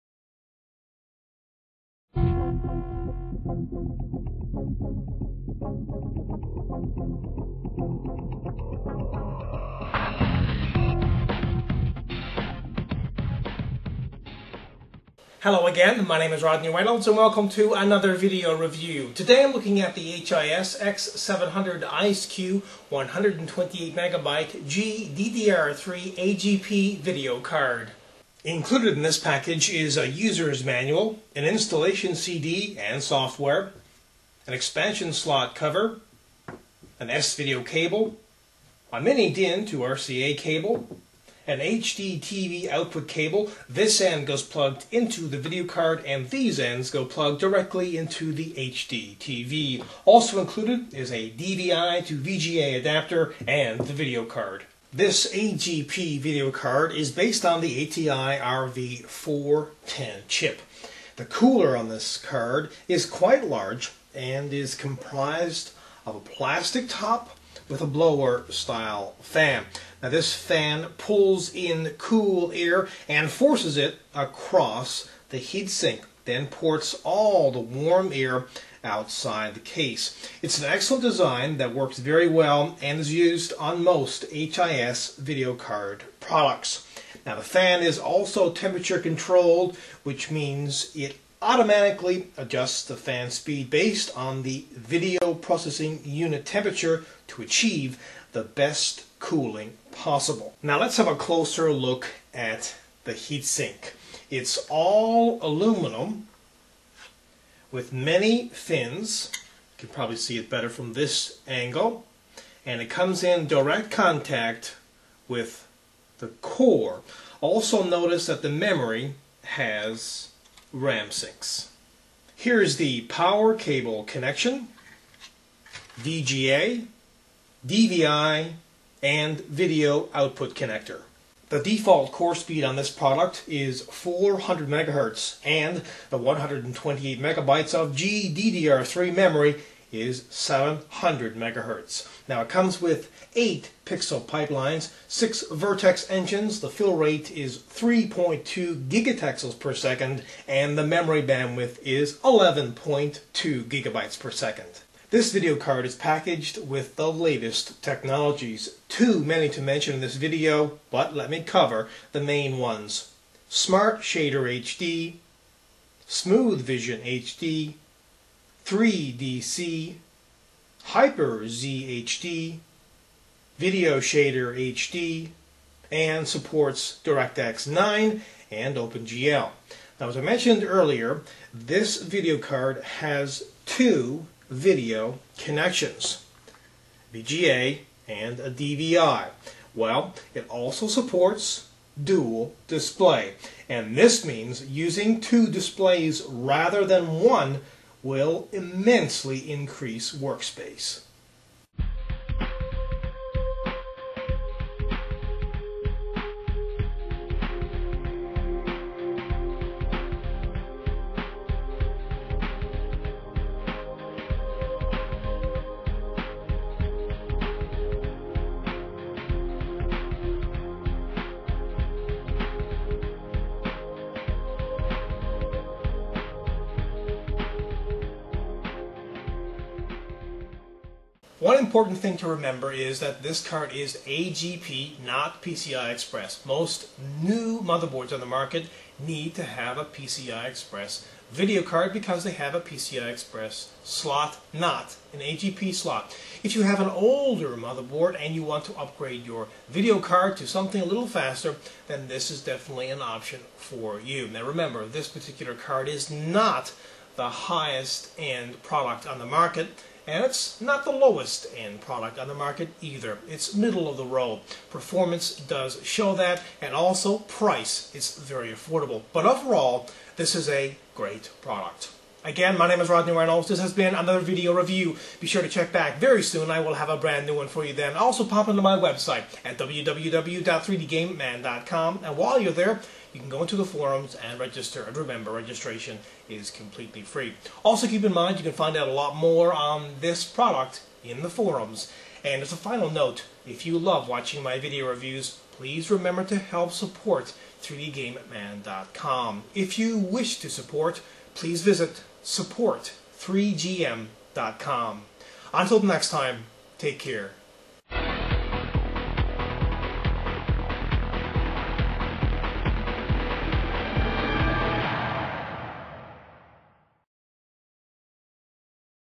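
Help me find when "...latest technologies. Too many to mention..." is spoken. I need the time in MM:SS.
02:37.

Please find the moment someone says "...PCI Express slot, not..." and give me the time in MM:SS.
04:02.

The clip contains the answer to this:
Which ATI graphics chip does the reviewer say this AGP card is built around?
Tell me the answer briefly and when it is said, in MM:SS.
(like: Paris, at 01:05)
ATI RV410, at 00:57.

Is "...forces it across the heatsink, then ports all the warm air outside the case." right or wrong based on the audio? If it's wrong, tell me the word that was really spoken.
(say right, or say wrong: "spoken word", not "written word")
right.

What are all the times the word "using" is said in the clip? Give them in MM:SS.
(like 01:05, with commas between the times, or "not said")
03:14.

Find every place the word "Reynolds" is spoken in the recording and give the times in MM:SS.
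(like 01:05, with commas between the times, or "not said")
00:16, 04:33.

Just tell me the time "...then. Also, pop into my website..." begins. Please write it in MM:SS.
04:37.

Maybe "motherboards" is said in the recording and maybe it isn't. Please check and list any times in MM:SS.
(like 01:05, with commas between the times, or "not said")
03:57, 04:07.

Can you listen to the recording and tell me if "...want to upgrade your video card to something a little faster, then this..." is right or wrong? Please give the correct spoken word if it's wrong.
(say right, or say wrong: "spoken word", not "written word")
right.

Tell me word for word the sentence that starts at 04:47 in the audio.
Also, keep in mind, you can find out a lot more on this product in the forums.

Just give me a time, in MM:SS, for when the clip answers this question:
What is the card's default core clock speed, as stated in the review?
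02:13.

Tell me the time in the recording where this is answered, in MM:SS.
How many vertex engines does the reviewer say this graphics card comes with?
02:25.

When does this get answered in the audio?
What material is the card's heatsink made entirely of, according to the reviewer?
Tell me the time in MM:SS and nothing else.
01:45.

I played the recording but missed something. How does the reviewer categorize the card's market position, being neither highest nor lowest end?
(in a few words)
Middle of the road.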